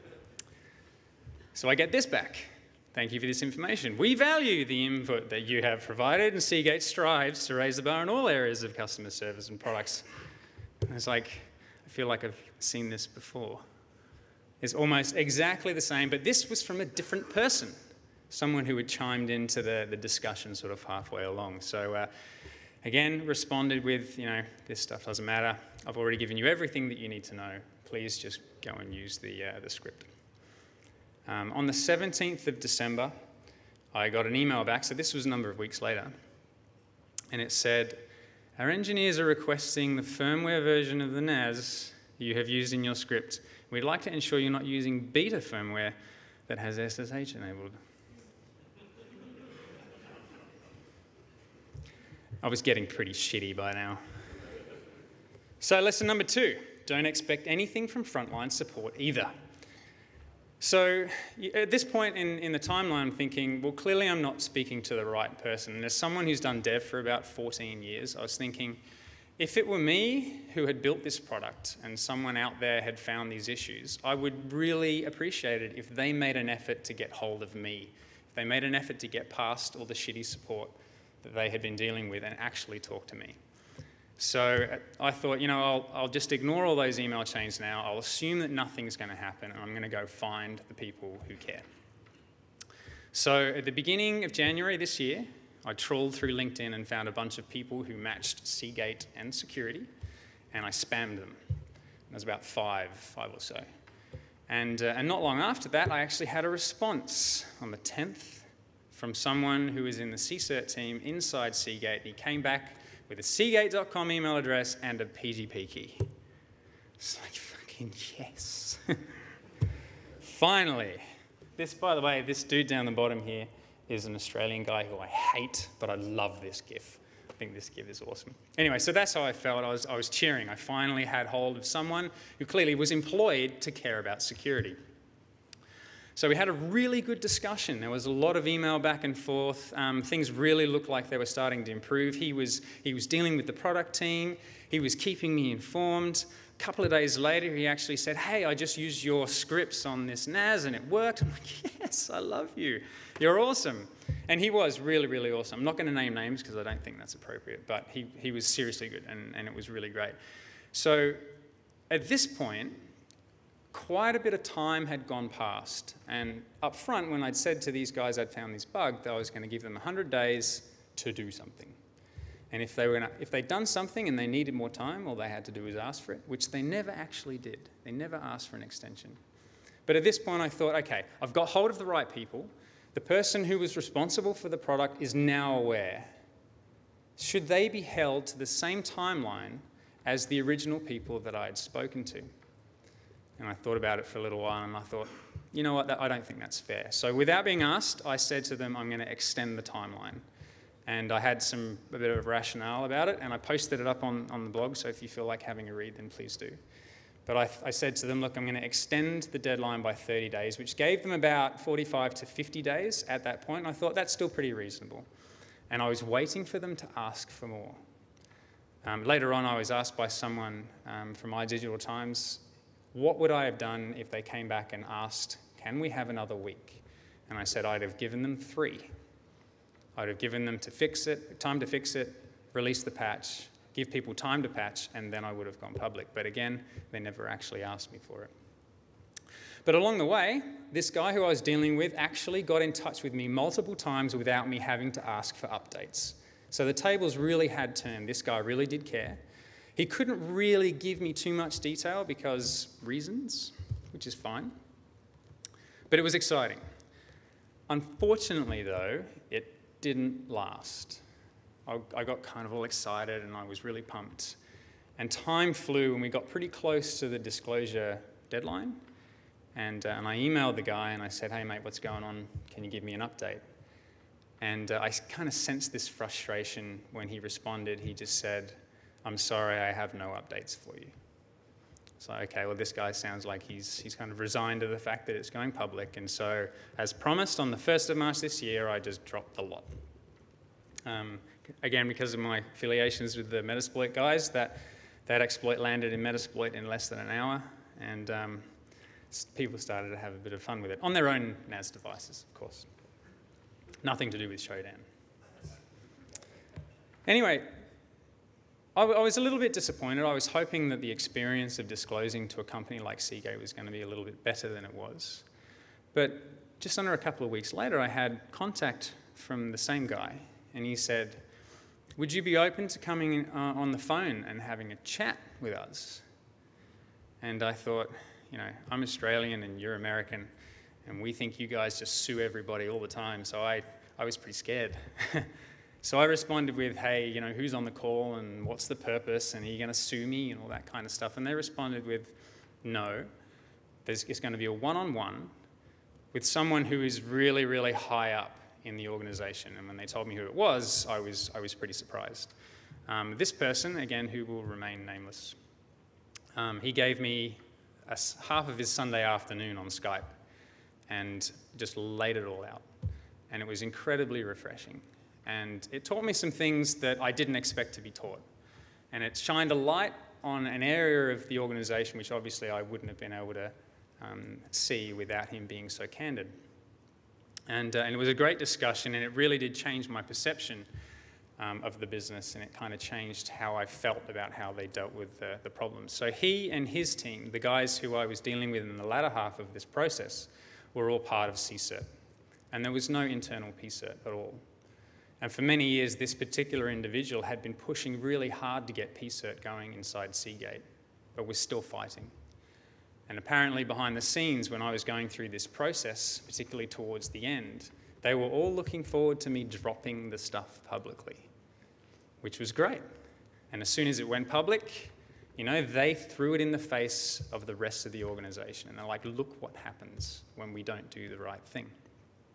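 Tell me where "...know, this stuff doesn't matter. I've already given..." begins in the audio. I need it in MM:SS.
00:24.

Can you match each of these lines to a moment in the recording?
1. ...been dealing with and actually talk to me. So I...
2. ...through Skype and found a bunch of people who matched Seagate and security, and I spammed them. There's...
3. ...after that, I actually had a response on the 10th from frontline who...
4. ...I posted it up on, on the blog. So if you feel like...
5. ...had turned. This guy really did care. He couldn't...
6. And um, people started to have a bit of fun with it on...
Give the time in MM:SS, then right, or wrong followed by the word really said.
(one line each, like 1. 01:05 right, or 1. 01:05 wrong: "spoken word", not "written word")
1. 01:21 right
2. 01:36 wrong: "LinkedIn", not "Skype"
3. 01:45 wrong: "someone", not "frontline"
4. 03:23 right
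5. 04:07 right
6. 04:57 right.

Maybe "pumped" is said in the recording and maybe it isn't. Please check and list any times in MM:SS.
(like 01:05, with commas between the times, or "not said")
04:23.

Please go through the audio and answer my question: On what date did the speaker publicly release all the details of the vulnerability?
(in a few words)
1st of March.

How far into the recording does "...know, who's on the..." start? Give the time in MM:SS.
05:37.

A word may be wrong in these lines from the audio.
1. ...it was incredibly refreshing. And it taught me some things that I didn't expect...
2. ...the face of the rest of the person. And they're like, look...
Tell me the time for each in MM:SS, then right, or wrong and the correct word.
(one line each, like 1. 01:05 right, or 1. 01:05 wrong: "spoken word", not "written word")
1. 06:03 right
2. 06:56 wrong: "organization", not "person".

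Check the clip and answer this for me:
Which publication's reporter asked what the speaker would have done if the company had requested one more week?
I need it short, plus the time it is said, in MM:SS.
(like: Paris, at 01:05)
iDigital Times, at 03:41.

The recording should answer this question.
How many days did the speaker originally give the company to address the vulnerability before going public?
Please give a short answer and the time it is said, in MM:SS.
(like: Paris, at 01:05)
100, at 02:49.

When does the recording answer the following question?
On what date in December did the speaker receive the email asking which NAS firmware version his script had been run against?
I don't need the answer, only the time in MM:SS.
00:31.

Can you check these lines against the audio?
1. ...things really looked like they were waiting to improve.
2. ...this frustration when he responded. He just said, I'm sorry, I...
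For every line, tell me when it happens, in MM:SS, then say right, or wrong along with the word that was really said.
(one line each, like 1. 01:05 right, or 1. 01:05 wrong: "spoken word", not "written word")
1. 02:20 wrong: "starting", not "waiting"
2. 04:35 right.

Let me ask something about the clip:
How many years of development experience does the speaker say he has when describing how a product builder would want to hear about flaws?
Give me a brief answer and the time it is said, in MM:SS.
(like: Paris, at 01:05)
14, at 01:07.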